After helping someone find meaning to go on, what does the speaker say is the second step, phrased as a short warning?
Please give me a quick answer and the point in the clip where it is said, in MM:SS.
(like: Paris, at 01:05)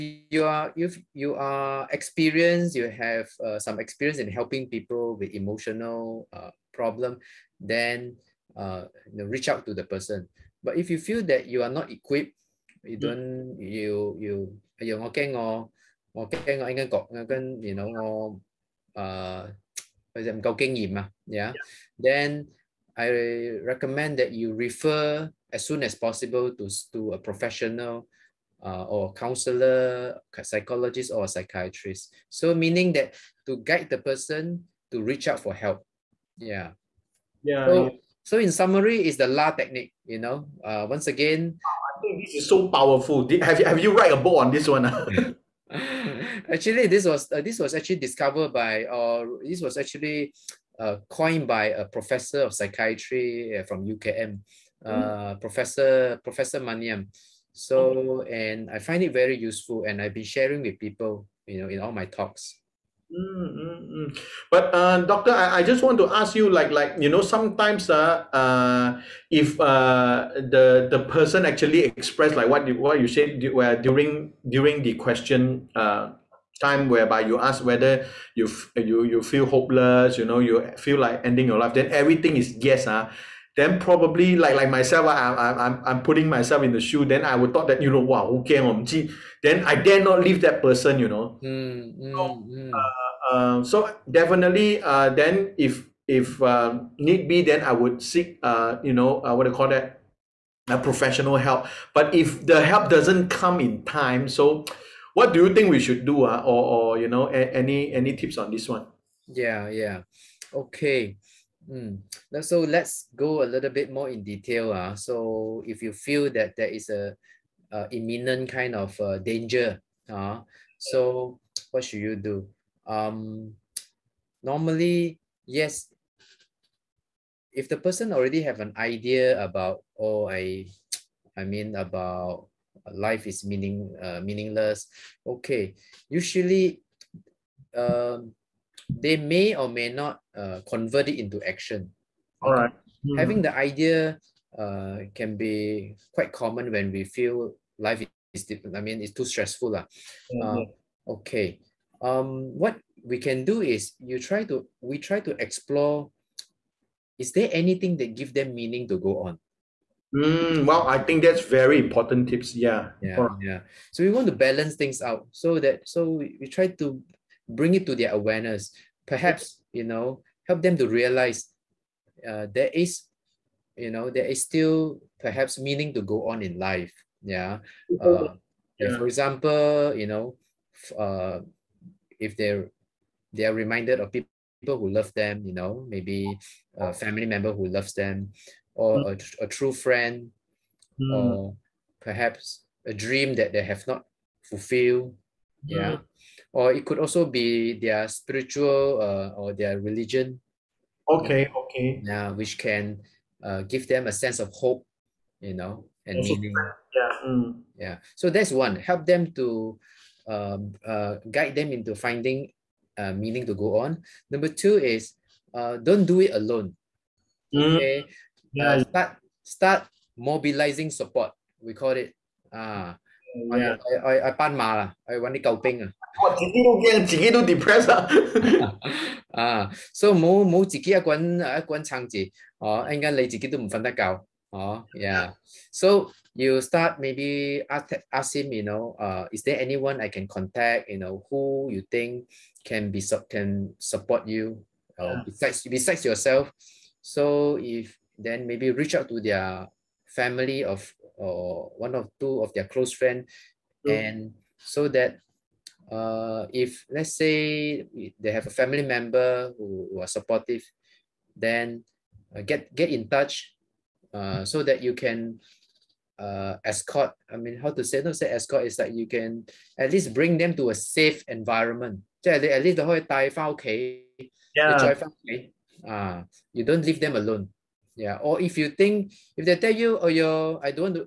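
Don't do it alone, at 03:35.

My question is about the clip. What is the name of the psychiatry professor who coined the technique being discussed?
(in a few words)
Professor Maniam.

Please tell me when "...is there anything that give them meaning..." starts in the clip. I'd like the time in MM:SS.
02:37.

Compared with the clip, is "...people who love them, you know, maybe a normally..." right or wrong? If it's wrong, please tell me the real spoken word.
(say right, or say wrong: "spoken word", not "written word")
wrong: "family", not "normally".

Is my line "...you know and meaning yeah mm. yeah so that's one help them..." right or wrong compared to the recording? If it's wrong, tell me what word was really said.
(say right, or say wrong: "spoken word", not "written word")
right.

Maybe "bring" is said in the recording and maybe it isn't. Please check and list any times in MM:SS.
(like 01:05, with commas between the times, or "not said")
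02:47, 04:30.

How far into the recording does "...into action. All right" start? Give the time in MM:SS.
02:21.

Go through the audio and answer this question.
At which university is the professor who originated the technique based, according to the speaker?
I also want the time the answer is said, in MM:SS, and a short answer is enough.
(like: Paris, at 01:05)
UKM, at 00:53.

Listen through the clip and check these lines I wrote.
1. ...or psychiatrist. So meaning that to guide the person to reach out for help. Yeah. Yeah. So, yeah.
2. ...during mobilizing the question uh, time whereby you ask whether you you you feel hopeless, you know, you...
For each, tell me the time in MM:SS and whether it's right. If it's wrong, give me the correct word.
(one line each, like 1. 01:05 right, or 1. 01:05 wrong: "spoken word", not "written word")
1. 00:31 right
2. 01:13 wrong: "during", not "mobilizing".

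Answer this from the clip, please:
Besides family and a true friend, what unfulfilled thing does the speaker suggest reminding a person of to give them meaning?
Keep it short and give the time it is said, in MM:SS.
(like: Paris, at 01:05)
A dream, at 03:12.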